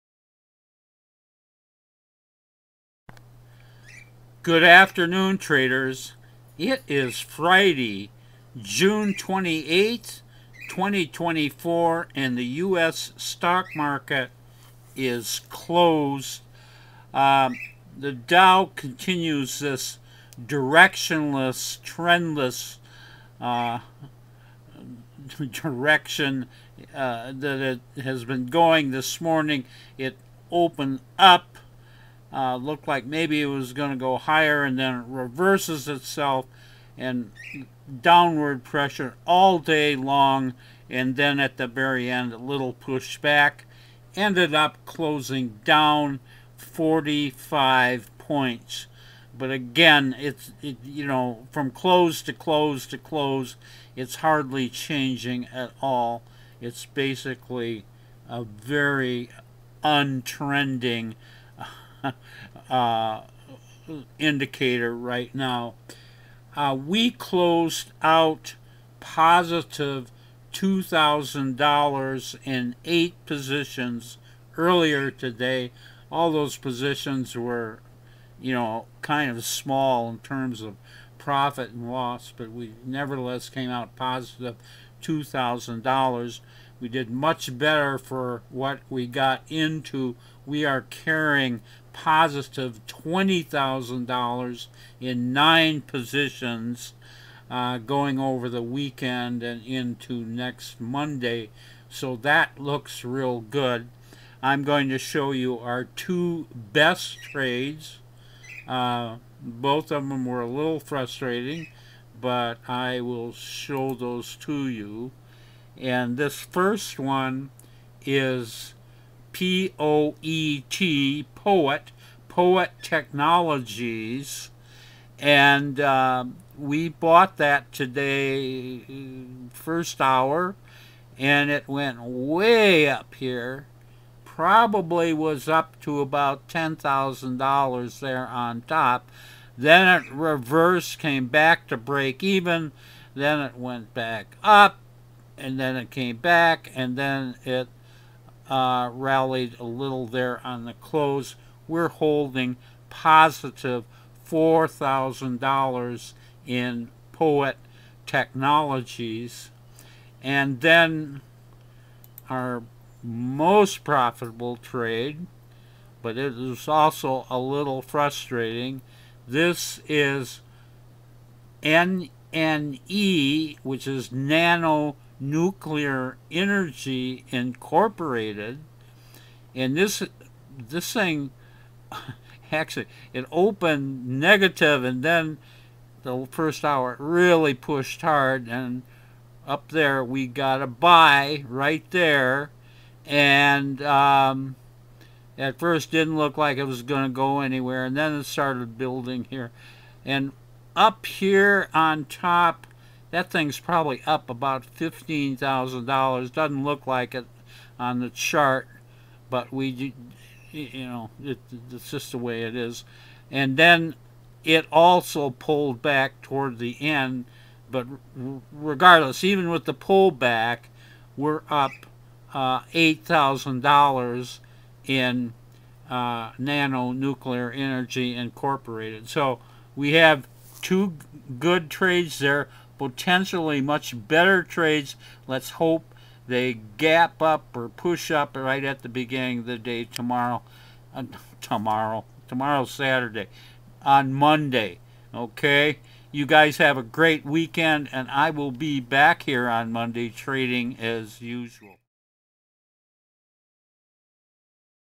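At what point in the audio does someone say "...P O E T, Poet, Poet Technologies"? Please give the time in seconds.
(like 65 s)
119 s.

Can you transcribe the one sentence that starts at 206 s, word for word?
Doesn't look like it on the chart, but we, you know, it, it's just the way it is.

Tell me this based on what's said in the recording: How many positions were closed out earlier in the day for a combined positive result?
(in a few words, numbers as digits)
8.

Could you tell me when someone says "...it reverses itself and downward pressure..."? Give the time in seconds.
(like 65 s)
34 s.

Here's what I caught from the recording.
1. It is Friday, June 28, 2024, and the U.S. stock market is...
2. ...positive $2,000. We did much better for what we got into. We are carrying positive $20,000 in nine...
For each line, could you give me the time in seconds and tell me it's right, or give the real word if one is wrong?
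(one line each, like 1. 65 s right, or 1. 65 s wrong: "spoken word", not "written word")
1. 6 s right
2. 83 s right.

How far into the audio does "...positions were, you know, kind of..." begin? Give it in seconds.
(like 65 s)
76 s.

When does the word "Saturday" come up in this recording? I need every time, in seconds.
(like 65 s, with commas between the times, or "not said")
242 s.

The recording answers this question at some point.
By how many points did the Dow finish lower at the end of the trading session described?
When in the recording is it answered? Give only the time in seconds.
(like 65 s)
46 s.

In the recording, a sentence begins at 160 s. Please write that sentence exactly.
And then our most profitable trade, but it is also a little frustrating.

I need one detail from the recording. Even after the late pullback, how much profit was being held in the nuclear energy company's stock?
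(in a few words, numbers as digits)
$8,000.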